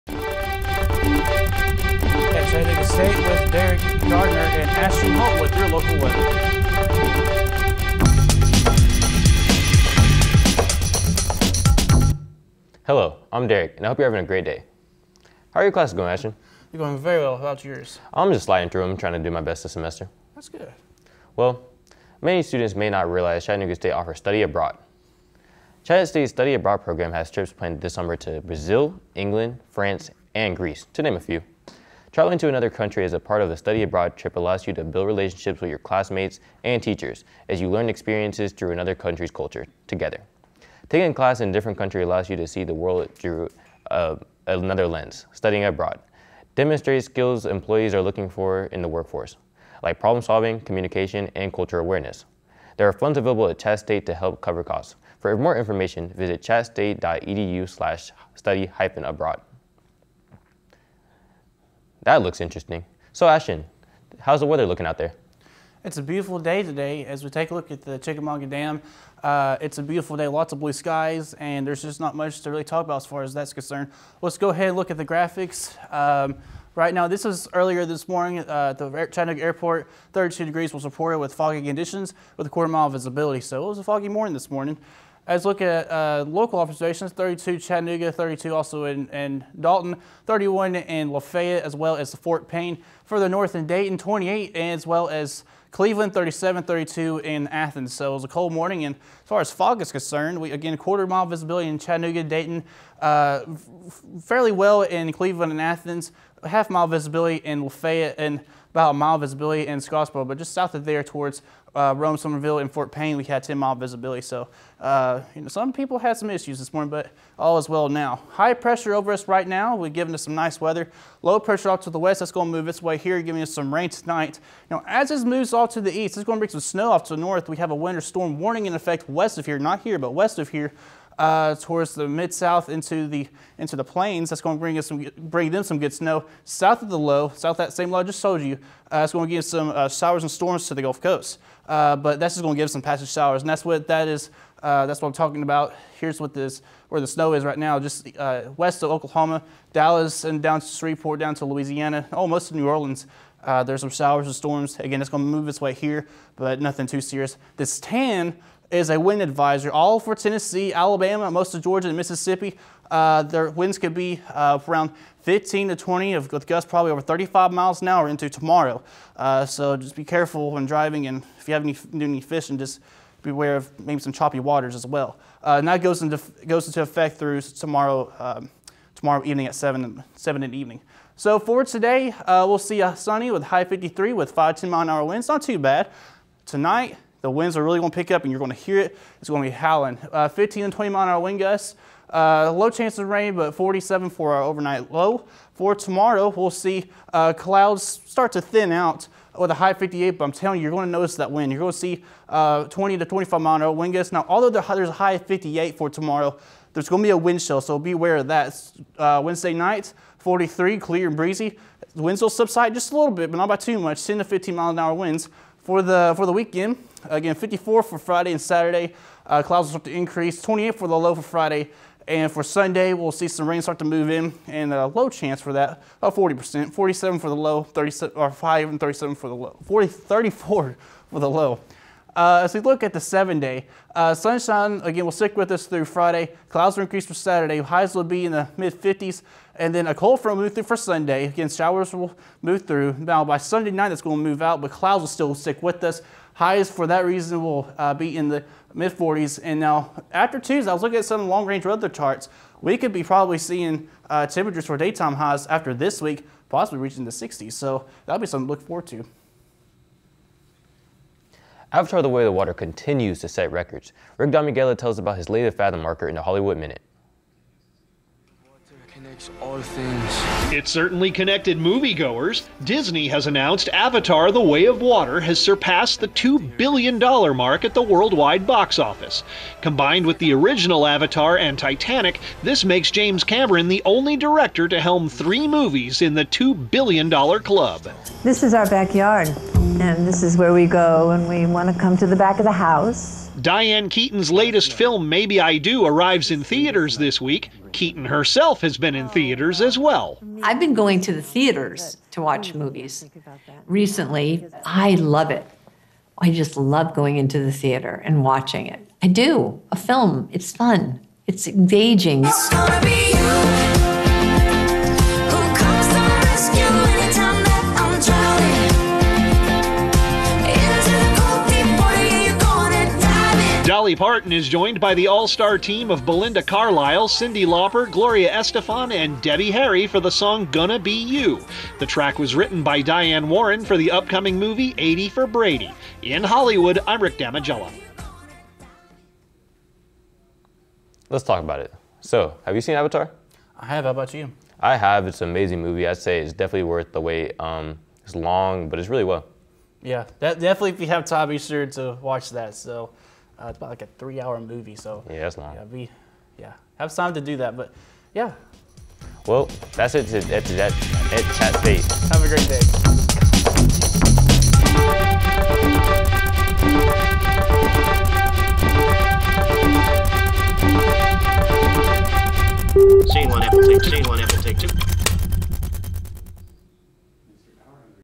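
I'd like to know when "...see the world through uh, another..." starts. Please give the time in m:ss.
0:42.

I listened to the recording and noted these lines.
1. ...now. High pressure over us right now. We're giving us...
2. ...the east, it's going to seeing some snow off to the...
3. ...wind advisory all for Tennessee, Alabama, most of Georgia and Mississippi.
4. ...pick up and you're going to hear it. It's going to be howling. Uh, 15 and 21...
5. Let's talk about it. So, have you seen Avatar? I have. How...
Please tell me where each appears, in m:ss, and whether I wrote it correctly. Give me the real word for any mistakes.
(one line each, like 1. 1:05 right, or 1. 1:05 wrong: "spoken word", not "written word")
1. 1:57 right
2. 2:05 wrong: "bring", not "seeing"
3. 2:38 right
4. 3:07 wrong: "20", not "21"
5. 5:41 right.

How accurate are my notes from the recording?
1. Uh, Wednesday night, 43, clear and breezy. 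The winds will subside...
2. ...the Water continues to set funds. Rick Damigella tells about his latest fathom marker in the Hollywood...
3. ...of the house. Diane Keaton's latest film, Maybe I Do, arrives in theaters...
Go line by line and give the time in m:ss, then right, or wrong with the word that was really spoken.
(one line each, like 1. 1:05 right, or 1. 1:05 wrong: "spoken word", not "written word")
1. 3:28 right
2. 4:22 wrong: "records", not "funds"
3. 4:52 right.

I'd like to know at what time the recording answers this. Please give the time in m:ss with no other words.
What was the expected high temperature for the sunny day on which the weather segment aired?
3:03.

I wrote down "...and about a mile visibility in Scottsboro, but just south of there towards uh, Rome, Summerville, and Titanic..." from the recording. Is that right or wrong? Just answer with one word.
wrong.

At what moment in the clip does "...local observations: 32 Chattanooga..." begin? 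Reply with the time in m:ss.
1:26.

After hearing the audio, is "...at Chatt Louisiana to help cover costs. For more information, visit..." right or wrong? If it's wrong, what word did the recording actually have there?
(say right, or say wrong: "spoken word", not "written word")
wrong: "State", not "Louisiana".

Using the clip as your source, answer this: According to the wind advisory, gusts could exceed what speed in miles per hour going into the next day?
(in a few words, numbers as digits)
35.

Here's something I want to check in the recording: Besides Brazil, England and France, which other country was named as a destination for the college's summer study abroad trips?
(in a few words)
Greece.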